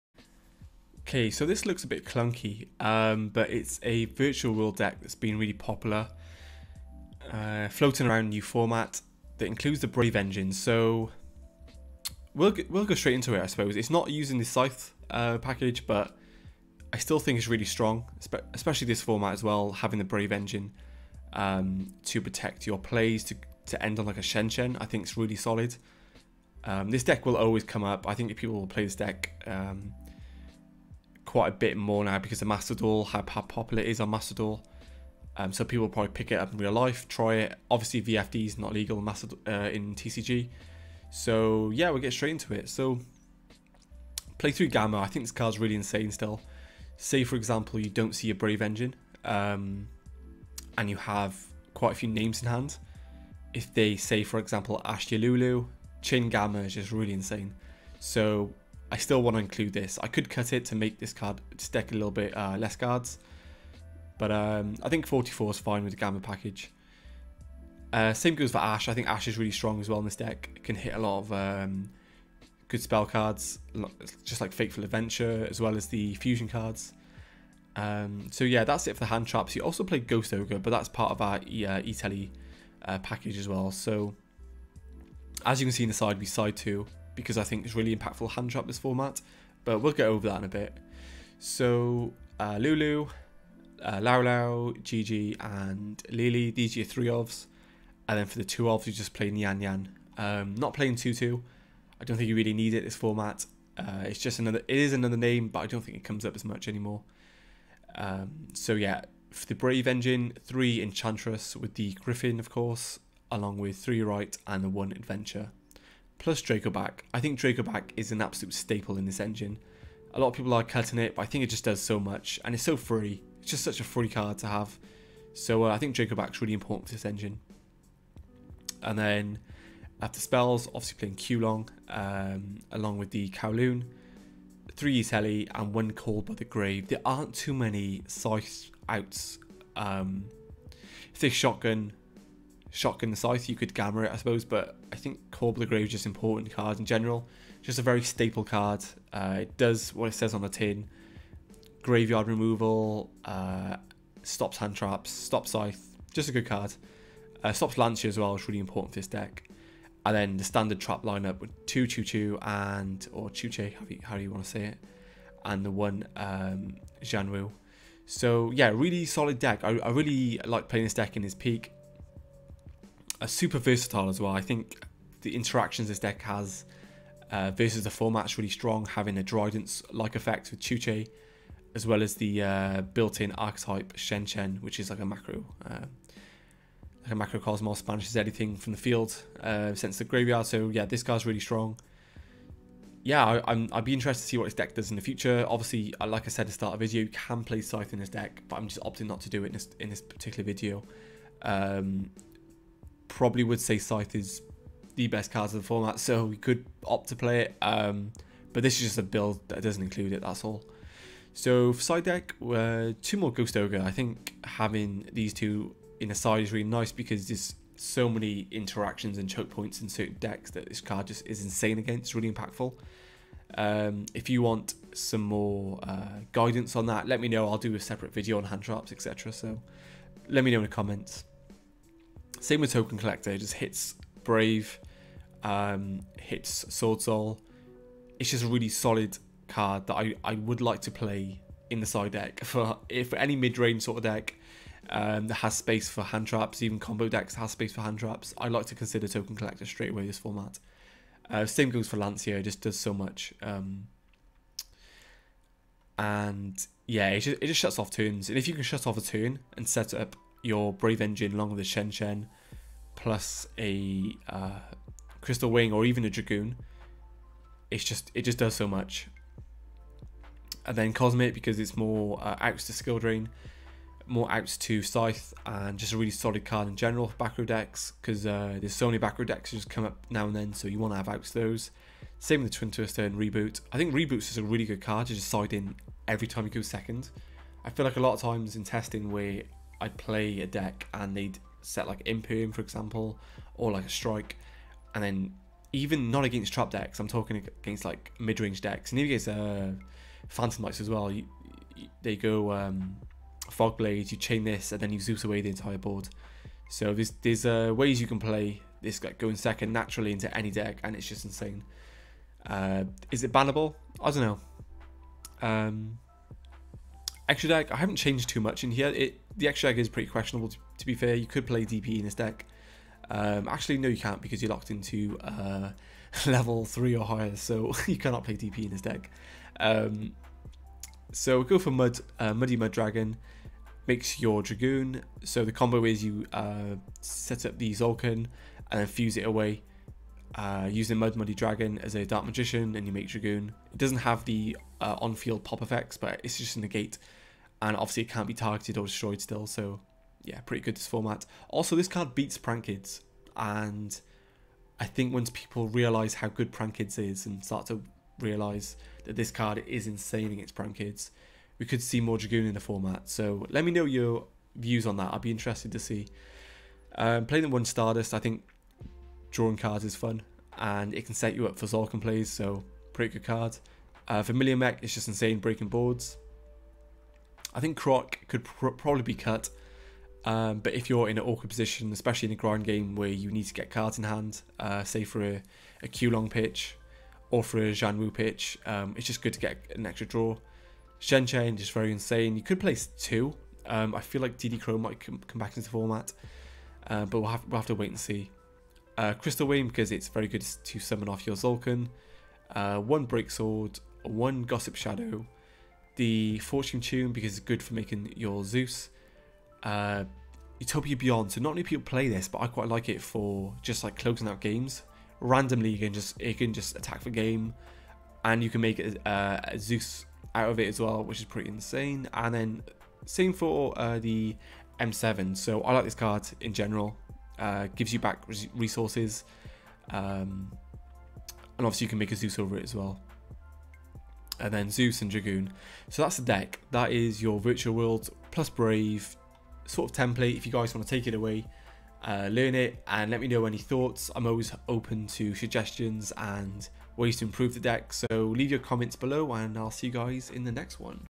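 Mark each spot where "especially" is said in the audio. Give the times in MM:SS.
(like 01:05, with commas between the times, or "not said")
00:18, 06:21.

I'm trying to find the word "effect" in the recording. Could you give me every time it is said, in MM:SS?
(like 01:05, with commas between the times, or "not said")
03:00, 05:45.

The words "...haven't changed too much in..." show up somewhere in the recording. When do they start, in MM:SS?
05:17.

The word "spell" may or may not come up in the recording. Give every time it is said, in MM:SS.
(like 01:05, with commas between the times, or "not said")
01:12, 02:10.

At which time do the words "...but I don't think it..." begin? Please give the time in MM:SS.
01:45.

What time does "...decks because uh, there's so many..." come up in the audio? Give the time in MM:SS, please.
04:37.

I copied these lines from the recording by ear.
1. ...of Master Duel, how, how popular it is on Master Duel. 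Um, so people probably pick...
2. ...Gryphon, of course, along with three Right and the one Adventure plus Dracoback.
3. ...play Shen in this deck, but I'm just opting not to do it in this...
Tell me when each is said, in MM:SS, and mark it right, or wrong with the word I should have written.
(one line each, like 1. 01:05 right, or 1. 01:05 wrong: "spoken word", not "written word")
1. 00:32 right
2. 01:51 right
3. 03:17 wrong: "Scythe", not "Shen".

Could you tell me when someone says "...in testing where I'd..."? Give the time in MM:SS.
04:48.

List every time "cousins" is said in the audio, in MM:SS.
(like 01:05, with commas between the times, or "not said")
not said.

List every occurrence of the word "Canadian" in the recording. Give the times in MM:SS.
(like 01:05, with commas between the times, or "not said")
not said.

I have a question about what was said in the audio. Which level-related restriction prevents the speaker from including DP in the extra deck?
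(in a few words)
level 3 or higher.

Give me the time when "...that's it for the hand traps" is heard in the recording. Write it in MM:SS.
01:18.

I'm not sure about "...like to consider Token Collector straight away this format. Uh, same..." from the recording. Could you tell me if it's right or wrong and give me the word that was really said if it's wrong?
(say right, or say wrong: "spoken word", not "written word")
right.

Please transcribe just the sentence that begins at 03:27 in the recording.
Um, but this is just a build that doesn't include it, that's all.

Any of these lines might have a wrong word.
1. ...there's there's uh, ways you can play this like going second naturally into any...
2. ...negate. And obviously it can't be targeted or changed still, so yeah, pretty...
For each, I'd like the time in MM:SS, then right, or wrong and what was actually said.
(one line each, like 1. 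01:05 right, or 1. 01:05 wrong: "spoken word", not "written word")
1. 05:06 right
2. 05:46 wrong: "destroyed", not "changed".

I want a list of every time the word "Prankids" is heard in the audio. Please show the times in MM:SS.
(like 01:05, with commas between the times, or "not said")
05:52, 05:56, 06:00.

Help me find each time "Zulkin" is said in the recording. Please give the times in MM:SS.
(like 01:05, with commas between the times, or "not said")
05:37, 06:41.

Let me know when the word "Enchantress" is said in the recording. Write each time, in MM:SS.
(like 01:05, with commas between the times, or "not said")
01:50.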